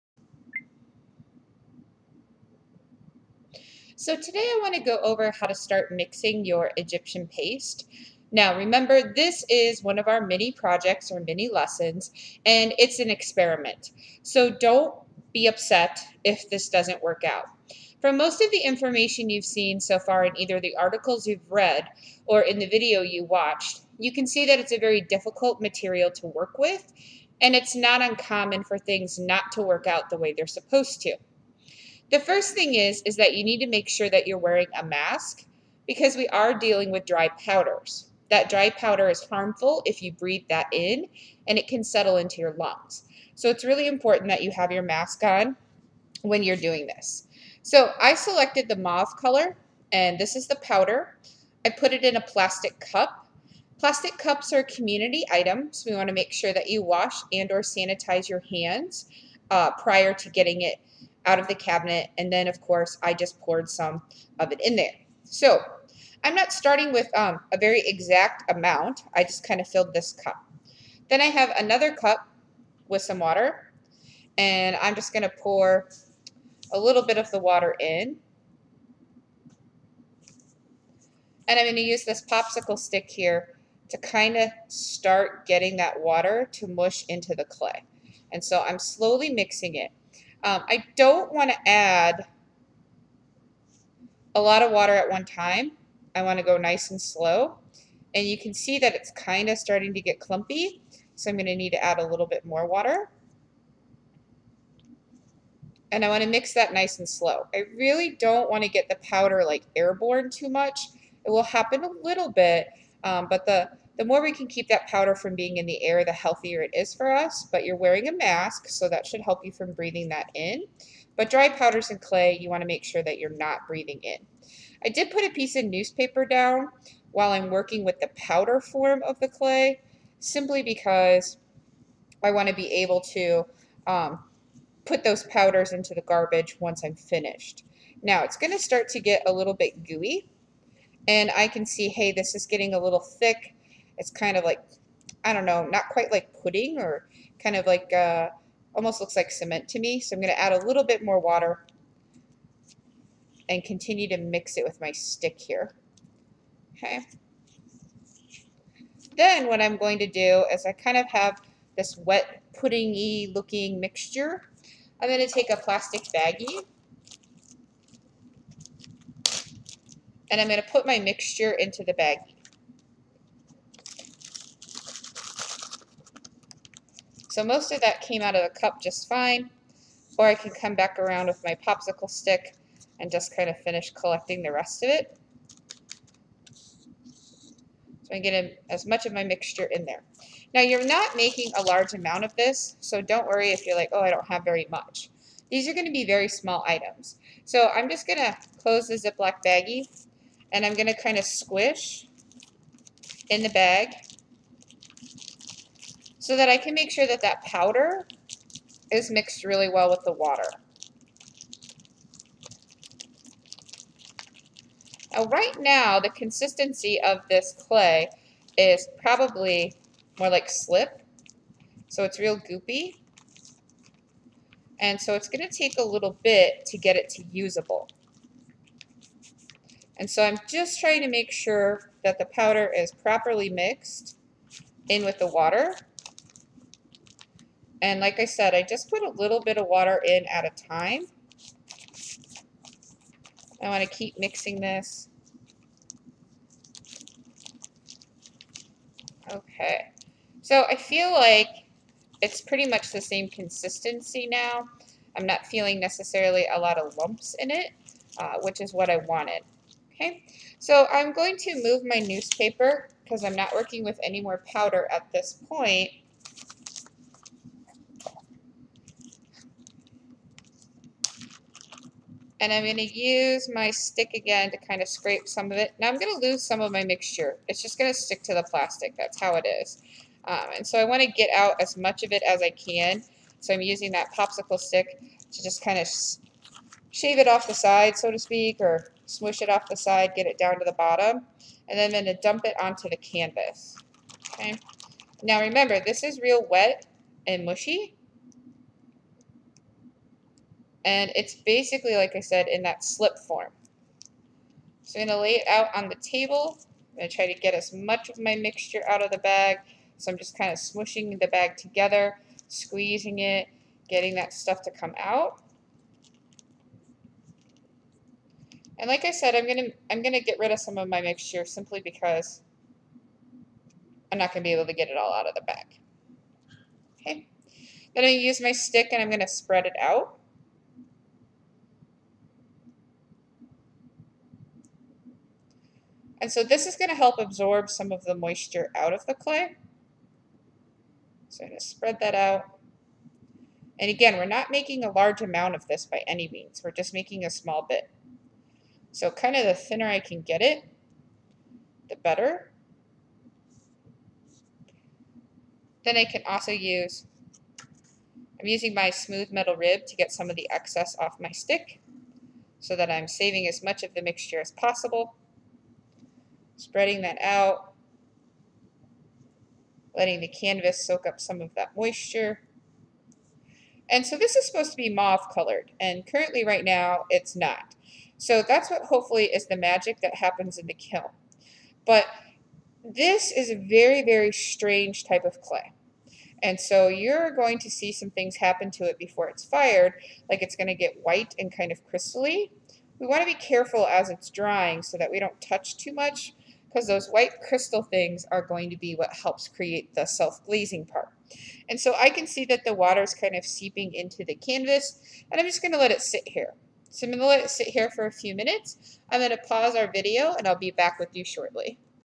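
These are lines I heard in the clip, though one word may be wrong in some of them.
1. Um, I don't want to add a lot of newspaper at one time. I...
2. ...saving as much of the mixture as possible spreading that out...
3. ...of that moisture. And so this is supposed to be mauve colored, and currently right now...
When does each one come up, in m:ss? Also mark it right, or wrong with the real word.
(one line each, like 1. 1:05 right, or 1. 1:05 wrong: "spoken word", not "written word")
1. 1:30 wrong: "water", not "newspaper"
2. 6:03 right
3. 6:11 right.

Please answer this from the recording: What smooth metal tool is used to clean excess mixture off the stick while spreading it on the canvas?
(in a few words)
Metal rib.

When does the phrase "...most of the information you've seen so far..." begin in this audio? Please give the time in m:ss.
0:18.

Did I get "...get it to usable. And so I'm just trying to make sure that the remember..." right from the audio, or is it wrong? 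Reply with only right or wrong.
wrong.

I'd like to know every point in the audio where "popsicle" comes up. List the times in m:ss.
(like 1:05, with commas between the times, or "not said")
1:22, 3:01, 4:44.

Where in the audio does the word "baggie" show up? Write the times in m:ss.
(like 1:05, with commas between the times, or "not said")
2:46, 2:51, 3:19.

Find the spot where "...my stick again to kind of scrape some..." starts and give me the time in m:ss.
4:33.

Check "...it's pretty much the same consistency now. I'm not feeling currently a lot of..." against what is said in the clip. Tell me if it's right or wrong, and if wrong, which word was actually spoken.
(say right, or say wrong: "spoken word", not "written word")
wrong: "necessarily", not "currently".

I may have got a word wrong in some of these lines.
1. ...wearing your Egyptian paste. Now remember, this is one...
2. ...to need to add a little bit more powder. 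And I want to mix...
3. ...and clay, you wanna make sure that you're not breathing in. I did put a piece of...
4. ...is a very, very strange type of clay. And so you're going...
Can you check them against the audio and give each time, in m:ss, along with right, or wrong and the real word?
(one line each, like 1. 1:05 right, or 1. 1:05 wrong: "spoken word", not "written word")
1. 0:05 wrong: "mixing", not "wearing"
2. 1:41 wrong: "water", not "powder"
3. 2:01 right
4. 6:23 right.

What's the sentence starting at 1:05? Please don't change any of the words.
So I'm not starting with um, a very exact amount.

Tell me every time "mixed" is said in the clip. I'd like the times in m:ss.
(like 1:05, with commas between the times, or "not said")
3:29, 3:53.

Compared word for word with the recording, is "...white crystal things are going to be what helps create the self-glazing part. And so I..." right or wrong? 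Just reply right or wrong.
right.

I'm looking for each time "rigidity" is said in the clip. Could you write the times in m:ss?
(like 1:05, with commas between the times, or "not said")
not said.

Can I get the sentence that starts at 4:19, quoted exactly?
Okay, so I'm going to move my newspaper because I'm not working with any more powder at this point.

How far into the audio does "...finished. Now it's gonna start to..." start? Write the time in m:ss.
2:16.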